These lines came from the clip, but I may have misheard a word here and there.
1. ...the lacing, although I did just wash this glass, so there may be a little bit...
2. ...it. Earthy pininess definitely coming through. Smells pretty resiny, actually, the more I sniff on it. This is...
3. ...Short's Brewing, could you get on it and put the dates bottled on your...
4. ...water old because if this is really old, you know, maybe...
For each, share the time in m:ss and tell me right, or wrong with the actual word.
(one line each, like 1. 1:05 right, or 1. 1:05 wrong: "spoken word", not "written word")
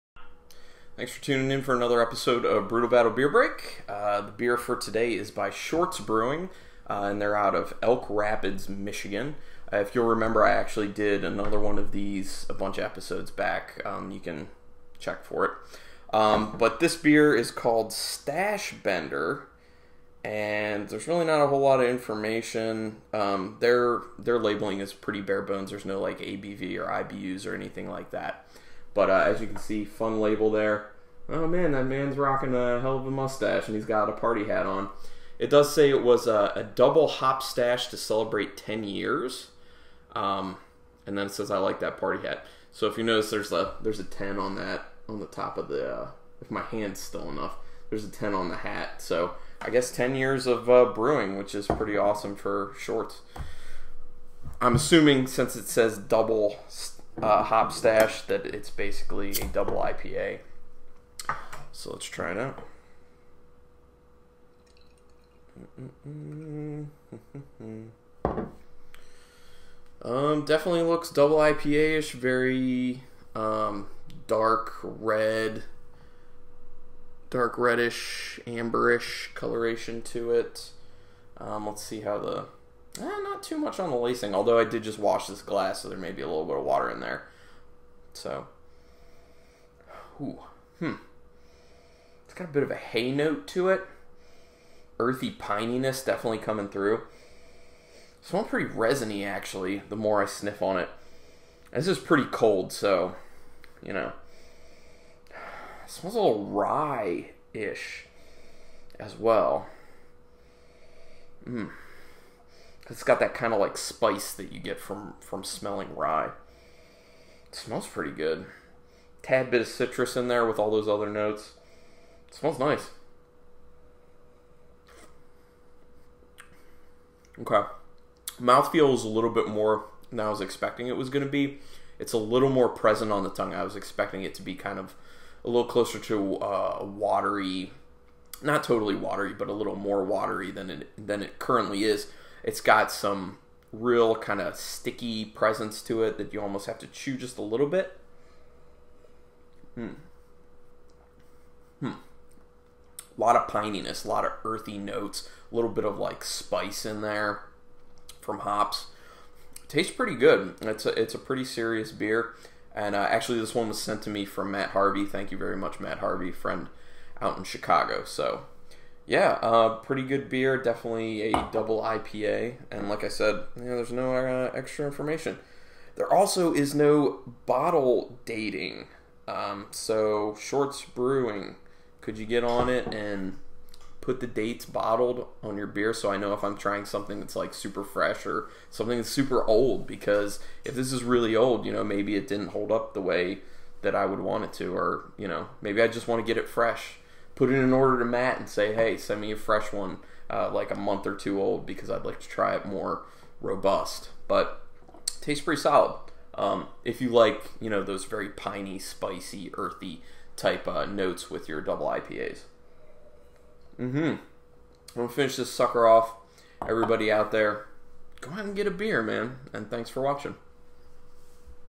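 1. 1:23 right
2. 1:33 right
3. 3:00 right
4. 3:09 wrong: "super", not "water".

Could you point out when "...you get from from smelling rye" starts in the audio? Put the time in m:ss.
1:54.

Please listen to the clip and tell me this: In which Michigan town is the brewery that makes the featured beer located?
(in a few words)
Elk Rapids.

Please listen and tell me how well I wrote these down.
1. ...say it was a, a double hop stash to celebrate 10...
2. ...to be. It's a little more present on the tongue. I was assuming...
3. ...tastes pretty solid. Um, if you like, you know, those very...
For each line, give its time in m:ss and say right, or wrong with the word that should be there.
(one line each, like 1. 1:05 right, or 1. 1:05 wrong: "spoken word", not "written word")
1. 0:35 right
2. 2:11 wrong: "expecting", not "assuming"
3. 3:25 right.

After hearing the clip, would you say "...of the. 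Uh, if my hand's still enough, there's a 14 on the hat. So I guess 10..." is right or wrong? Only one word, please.
wrong.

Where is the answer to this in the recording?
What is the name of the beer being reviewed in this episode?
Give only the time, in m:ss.
0:17.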